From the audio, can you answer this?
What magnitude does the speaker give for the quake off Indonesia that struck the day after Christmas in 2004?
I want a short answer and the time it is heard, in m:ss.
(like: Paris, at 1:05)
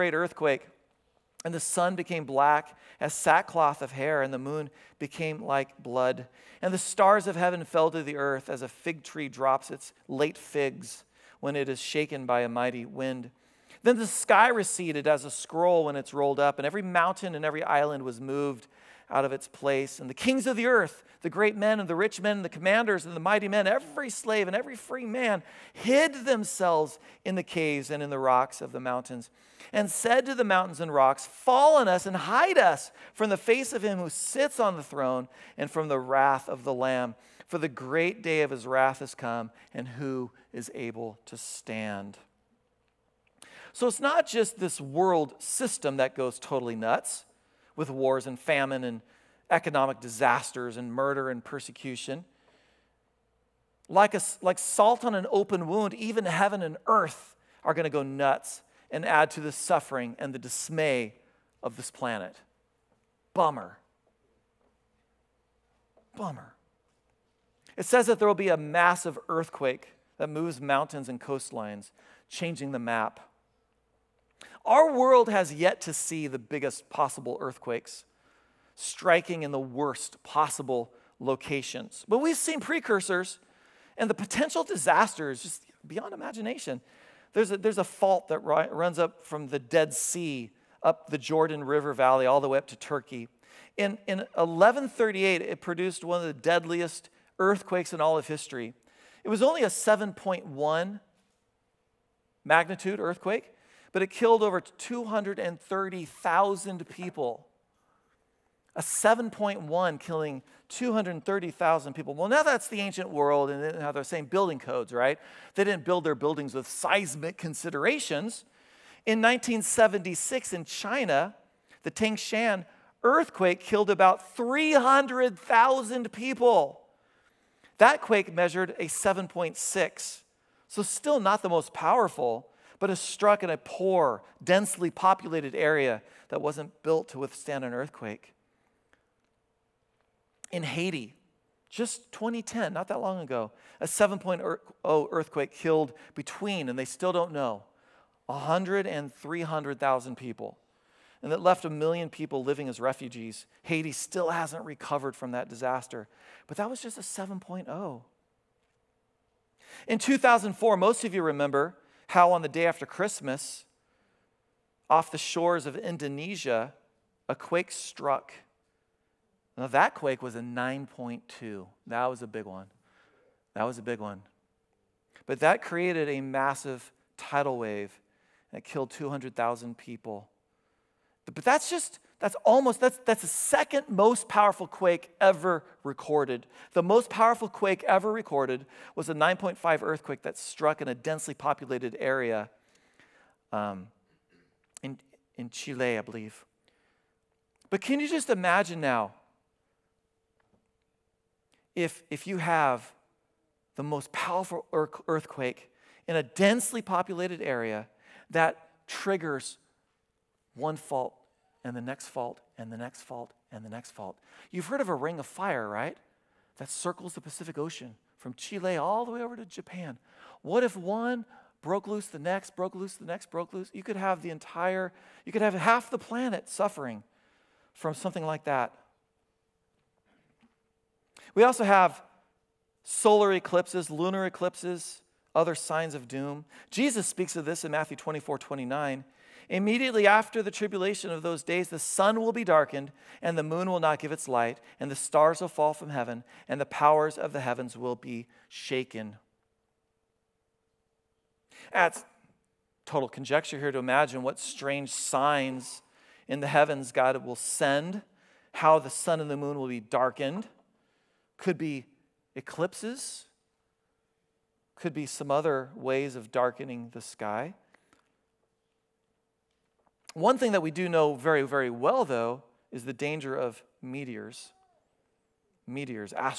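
9.2, at 2:50.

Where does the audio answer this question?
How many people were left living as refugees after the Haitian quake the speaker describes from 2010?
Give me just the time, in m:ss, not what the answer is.
2:31.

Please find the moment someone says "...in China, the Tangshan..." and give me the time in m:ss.
2:00.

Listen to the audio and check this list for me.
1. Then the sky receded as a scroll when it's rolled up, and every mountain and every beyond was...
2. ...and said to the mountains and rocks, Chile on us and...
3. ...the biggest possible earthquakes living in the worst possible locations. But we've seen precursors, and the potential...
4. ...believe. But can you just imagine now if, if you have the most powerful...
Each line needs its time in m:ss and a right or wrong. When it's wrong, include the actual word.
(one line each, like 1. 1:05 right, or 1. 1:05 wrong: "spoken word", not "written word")
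1. 0:13 wrong: "island", not "beyond"
2. 0:29 wrong: "Fall", not "Chile"
3. 1:16 wrong: "striking", not "living"
4. 3:16 right.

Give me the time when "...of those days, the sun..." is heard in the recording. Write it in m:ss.
4:01.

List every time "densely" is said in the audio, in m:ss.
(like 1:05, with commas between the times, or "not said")
2:14, 3:10, 3:26.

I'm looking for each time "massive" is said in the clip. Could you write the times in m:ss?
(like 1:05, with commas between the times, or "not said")
1:08, 2:56.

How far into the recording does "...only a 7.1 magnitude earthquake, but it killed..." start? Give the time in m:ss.
1:39.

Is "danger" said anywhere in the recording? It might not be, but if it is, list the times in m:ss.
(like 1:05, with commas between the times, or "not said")
4:32.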